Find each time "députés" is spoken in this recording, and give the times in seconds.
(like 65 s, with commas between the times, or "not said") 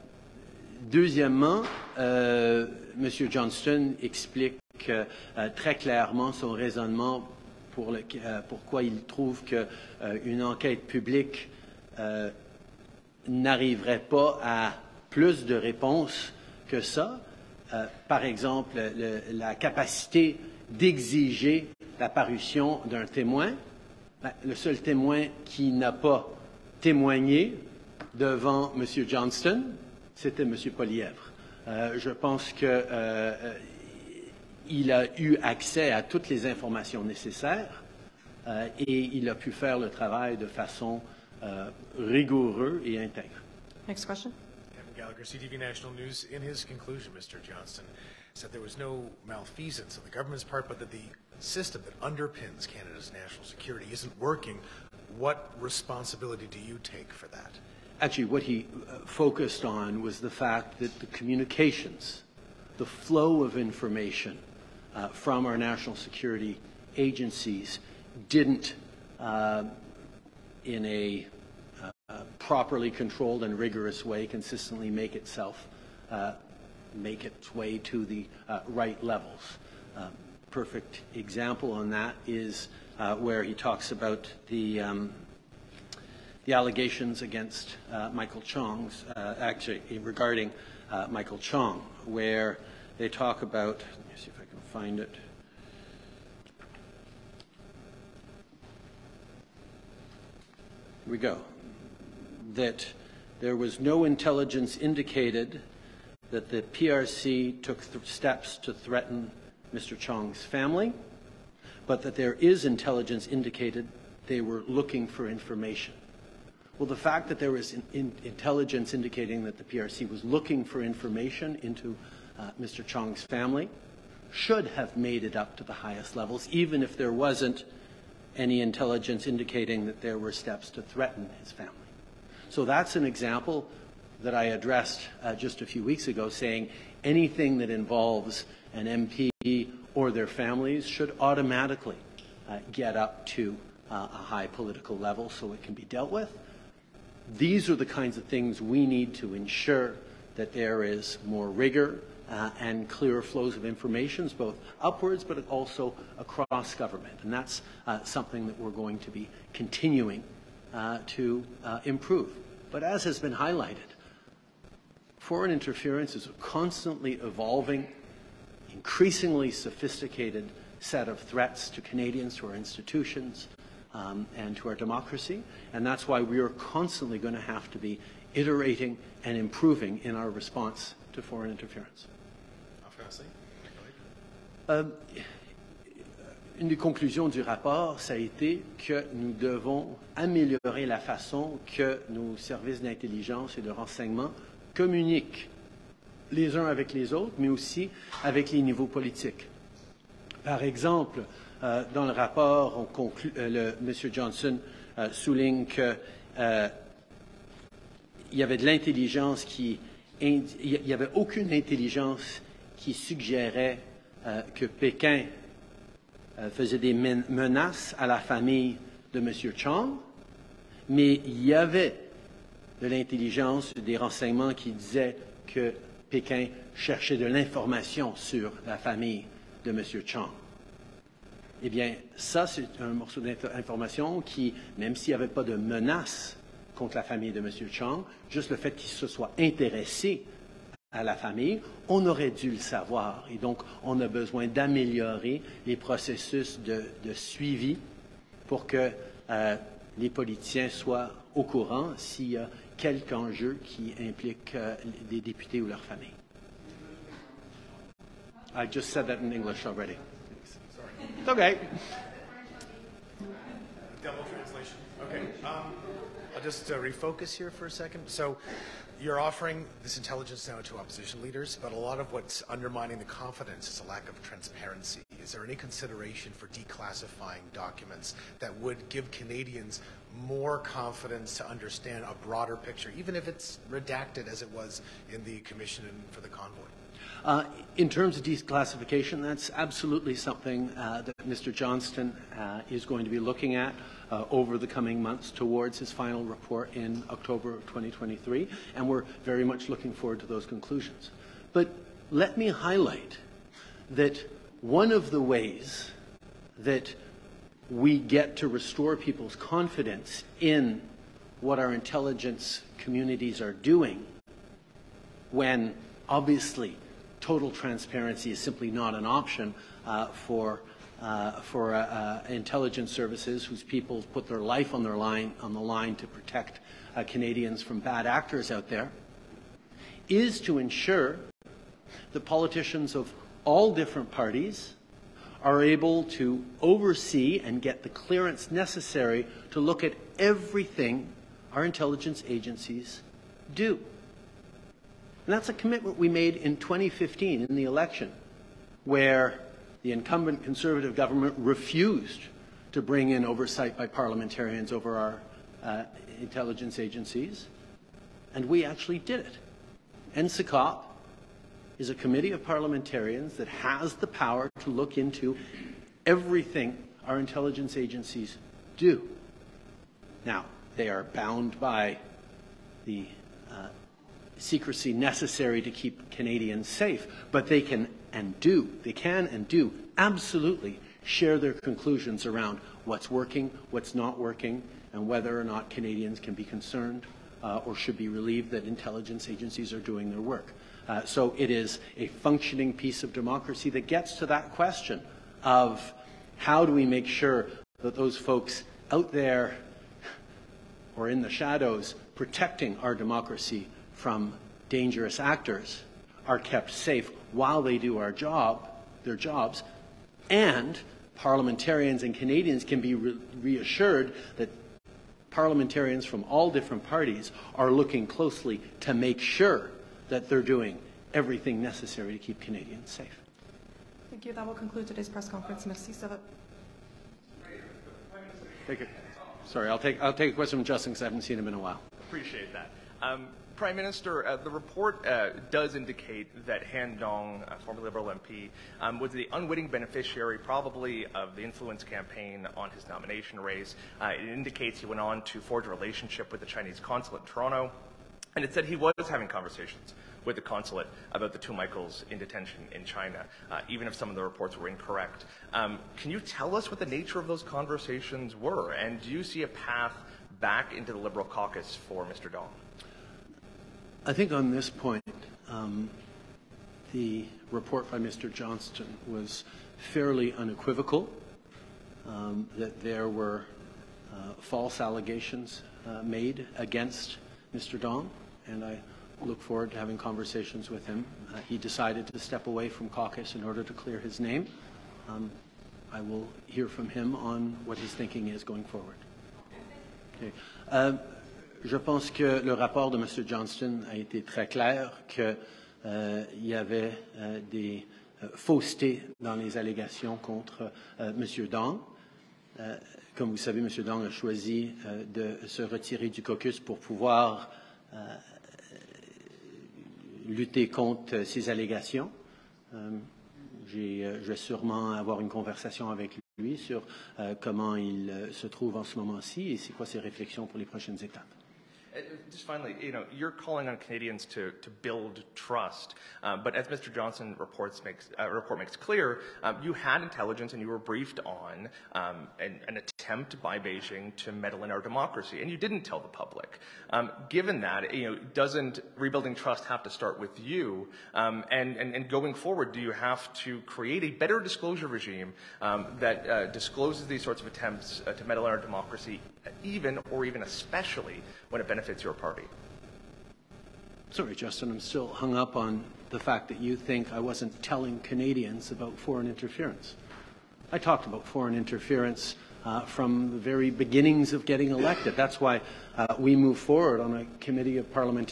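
255 s.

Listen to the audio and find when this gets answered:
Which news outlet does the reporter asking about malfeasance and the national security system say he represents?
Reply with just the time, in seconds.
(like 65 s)
45 s.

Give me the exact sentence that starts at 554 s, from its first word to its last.
Sorry, Justin, I'm still hung up on the fact that you think I wasn't telling Canadians about foreign interference.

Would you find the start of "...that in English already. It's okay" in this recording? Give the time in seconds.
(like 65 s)
259 s.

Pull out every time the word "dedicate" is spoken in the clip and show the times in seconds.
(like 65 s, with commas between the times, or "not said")
not said.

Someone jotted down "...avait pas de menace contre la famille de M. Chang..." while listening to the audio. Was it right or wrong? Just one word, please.
right.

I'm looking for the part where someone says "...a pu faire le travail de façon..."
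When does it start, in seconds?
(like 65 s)
39 s.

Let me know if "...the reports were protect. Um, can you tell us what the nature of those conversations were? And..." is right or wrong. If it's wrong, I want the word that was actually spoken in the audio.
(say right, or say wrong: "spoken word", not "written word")
wrong: "incorrect", not "protect".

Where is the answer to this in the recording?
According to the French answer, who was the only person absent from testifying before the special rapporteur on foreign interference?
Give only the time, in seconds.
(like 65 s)
30 s.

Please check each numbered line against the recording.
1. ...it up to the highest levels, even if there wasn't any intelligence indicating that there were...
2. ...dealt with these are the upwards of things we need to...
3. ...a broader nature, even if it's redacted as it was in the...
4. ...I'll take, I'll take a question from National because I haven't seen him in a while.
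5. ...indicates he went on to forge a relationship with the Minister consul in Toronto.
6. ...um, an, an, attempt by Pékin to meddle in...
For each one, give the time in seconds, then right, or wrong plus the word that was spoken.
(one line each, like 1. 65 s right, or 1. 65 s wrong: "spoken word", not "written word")
1. 125 s right
2. 145 s wrong: "kinds", not "upwards"
3. 282 s wrong: "picture", not "nature"
4. 429 s wrong: "Justin", not "National"
5. 444 s wrong: "Chinese", not "Minister"
6. 531 s wrong: "Beijing", not "Pékin".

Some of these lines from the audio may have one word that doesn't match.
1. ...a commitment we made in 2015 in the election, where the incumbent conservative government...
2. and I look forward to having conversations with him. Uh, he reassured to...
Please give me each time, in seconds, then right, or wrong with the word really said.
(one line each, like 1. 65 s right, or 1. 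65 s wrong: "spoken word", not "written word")
1. 345 s right
2. 478 s wrong: "decided", not "reassured".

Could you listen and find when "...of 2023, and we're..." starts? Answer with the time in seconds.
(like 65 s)
297 s.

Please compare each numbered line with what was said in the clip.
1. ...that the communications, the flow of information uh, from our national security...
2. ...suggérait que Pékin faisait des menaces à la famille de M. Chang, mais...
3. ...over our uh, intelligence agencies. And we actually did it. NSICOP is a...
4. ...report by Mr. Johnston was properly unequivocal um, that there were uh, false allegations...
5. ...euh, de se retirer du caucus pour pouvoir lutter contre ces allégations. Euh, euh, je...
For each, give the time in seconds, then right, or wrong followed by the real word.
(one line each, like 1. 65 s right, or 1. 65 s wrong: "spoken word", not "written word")
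1. 60 s right
2. 212 s right
3. 354 s right
4. 467 s wrong: "fairly", not "properly"
5. 504 s right.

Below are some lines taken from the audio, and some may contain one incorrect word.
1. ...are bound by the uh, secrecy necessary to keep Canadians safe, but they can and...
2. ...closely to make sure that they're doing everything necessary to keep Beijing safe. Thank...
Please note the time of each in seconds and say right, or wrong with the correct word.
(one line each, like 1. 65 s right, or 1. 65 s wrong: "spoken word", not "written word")
1. 370 s right
2. 418 s wrong: "Canadians", not "Beijing".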